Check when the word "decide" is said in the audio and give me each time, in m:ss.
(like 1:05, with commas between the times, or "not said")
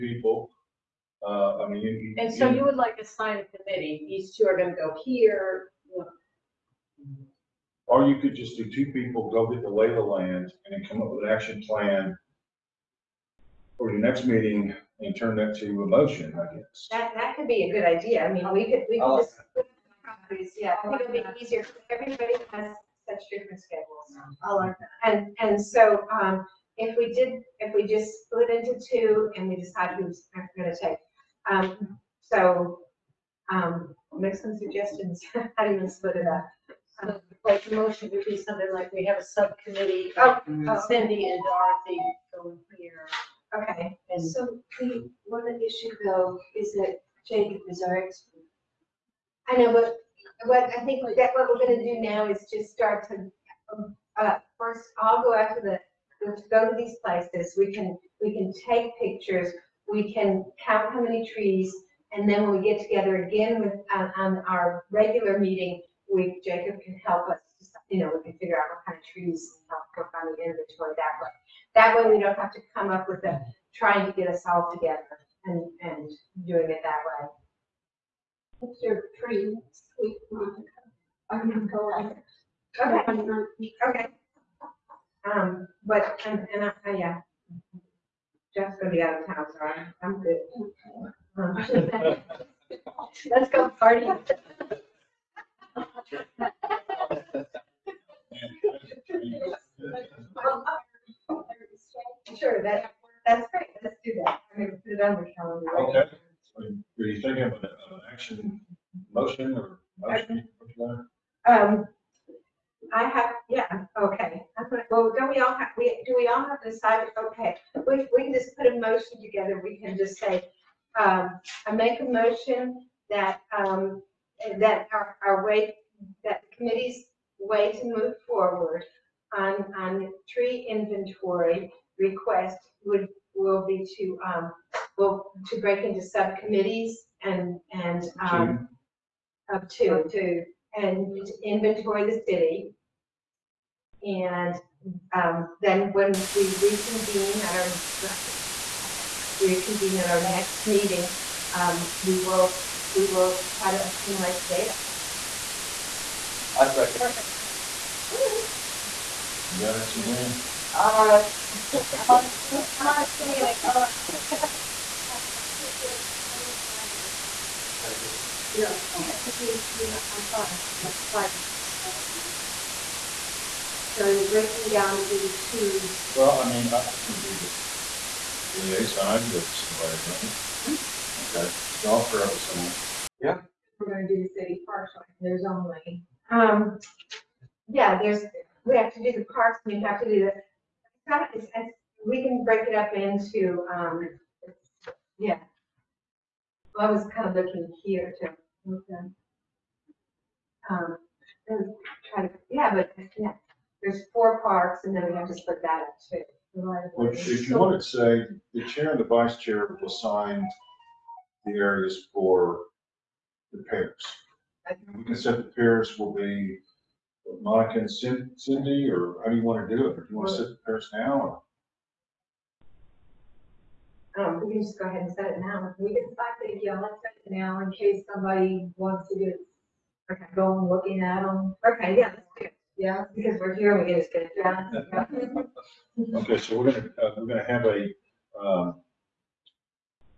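0:29, 1:56.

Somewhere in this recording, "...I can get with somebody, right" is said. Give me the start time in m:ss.
2:59.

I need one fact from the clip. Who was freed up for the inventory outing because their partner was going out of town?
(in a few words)
Jeff.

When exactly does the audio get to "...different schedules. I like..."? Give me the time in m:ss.
0:23.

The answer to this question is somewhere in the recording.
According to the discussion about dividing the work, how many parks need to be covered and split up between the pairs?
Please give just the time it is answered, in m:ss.
3:24.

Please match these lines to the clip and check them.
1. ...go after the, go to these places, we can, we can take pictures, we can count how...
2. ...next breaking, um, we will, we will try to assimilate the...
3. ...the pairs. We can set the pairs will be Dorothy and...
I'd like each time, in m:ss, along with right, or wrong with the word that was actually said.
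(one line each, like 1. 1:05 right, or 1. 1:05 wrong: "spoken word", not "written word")
1. 0:55 right
2. 2:30 wrong: "meeting", not "breaking"
3. 3:33 wrong: "Monica", not "Dorothy".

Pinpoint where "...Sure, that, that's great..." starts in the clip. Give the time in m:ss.
1:42.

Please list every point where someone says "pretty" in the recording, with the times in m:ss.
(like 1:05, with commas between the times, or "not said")
1:19.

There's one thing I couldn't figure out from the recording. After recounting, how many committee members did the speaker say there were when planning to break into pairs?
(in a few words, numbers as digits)
5.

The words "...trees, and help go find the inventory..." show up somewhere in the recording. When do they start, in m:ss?
1:09.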